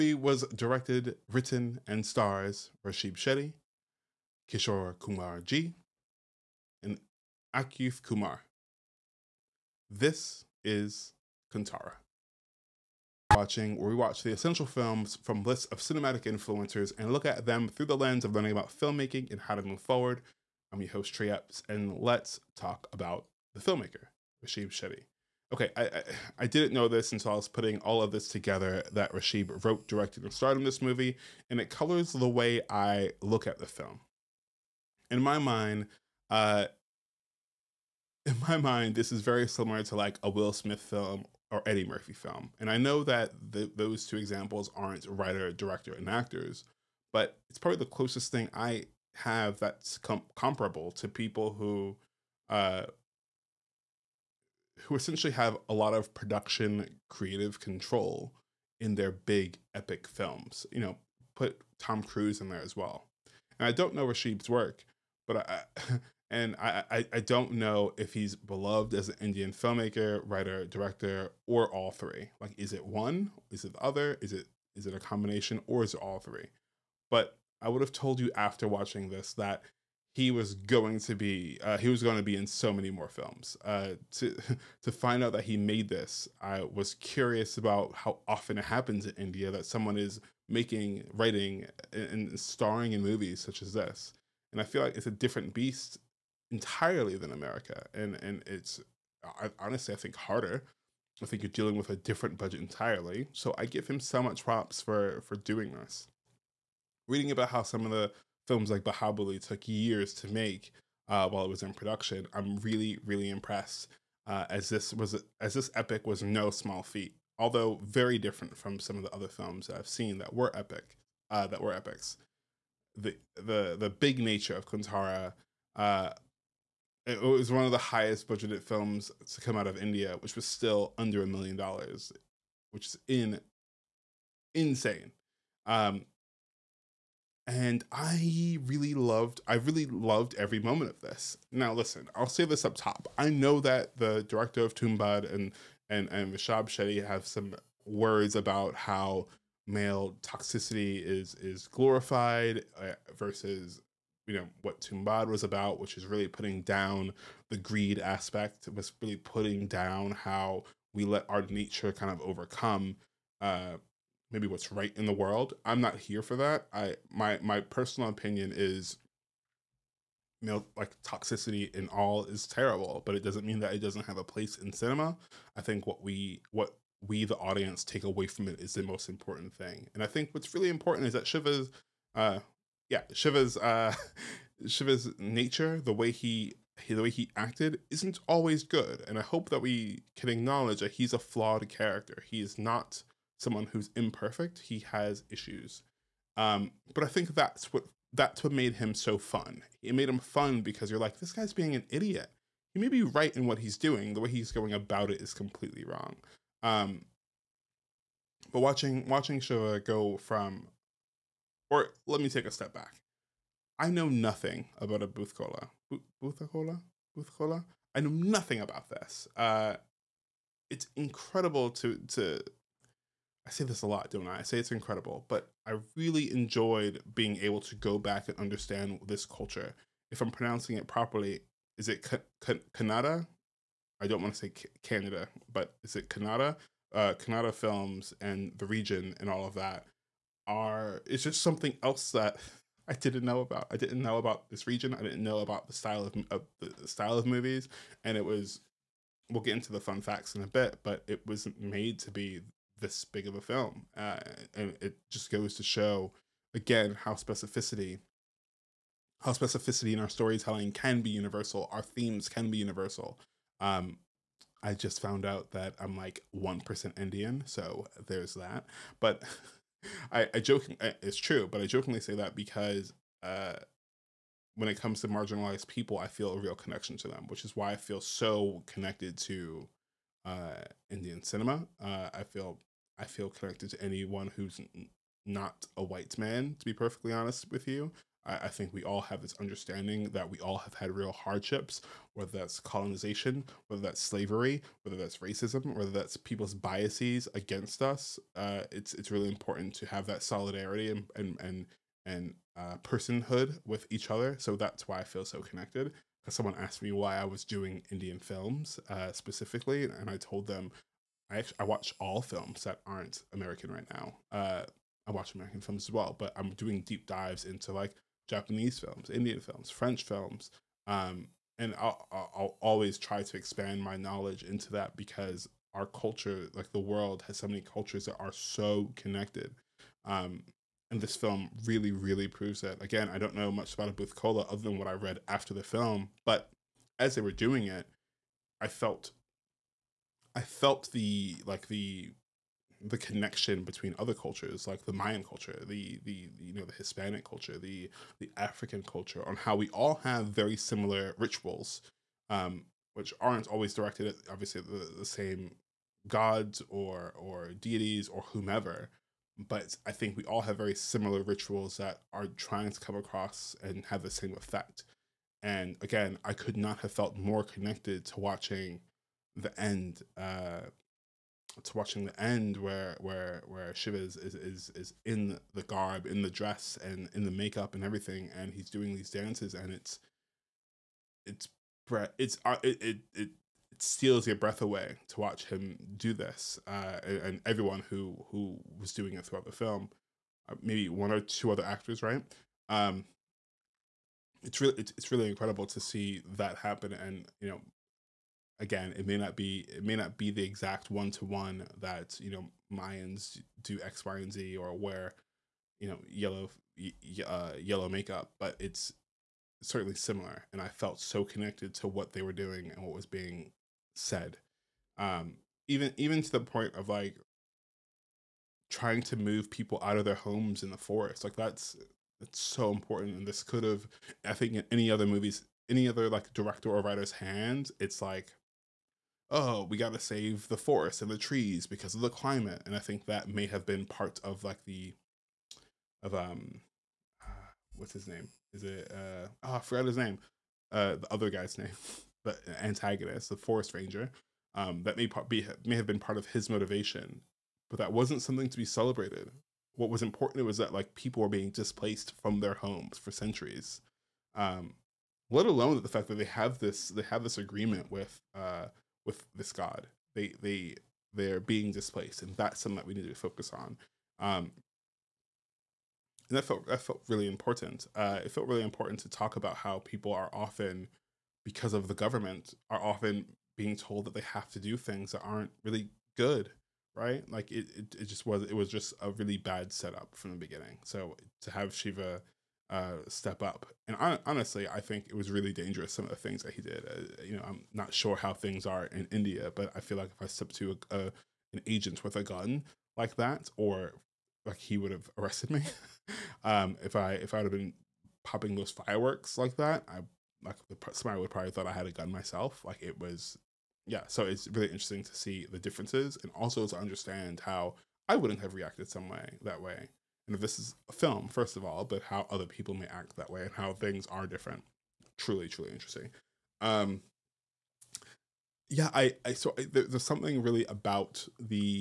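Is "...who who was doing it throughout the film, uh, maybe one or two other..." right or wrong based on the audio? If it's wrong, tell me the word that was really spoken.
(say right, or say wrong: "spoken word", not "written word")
right.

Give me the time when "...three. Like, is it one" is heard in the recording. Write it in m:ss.
1:11.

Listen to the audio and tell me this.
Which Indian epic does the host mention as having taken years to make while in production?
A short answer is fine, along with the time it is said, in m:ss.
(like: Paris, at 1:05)
Bahubali, at 1:48.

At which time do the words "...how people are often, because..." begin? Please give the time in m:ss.
7:49.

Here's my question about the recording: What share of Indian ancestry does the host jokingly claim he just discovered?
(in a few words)
1 percent.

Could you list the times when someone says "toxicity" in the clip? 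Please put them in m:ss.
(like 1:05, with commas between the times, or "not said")
2:30, 2:51.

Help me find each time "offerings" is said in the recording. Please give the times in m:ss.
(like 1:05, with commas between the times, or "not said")
not said.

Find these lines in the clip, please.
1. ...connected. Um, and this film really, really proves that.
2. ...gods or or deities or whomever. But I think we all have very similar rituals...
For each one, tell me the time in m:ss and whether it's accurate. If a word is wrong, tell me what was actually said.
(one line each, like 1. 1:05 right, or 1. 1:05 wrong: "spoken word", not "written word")
1. 5:28 right
2. 5:56 right.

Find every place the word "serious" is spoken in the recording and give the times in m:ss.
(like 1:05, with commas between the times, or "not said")
not said.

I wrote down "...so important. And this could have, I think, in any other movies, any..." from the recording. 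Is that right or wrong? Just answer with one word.
right.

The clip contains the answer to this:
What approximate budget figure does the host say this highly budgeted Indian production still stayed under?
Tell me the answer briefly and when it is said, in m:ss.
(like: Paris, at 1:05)
a million dollars, at 2:11.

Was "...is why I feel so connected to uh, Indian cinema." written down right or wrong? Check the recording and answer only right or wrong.
right.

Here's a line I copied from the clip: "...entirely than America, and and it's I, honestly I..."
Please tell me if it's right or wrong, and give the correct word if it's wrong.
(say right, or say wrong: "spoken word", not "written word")
right.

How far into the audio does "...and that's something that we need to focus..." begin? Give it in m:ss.
7:42.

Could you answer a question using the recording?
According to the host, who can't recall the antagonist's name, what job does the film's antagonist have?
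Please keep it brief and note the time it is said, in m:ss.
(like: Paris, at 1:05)
forest ranger, at 7:23.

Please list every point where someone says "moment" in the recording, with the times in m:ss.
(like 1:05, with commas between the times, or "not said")
2:20.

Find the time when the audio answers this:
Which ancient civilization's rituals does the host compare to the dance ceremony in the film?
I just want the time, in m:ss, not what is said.
5:44.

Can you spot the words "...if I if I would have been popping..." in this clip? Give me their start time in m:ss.
8:16.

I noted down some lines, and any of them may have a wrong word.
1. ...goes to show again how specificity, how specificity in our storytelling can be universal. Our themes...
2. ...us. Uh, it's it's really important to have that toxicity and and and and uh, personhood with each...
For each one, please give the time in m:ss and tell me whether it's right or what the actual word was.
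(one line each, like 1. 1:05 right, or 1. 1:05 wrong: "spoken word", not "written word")
1. 4:15 right
2. 4:57 wrong: "solidarity", not "toxicity".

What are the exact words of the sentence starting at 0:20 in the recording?
I'm your host Tray Epps, and let's talk about the filmmaker Rashid Shetty.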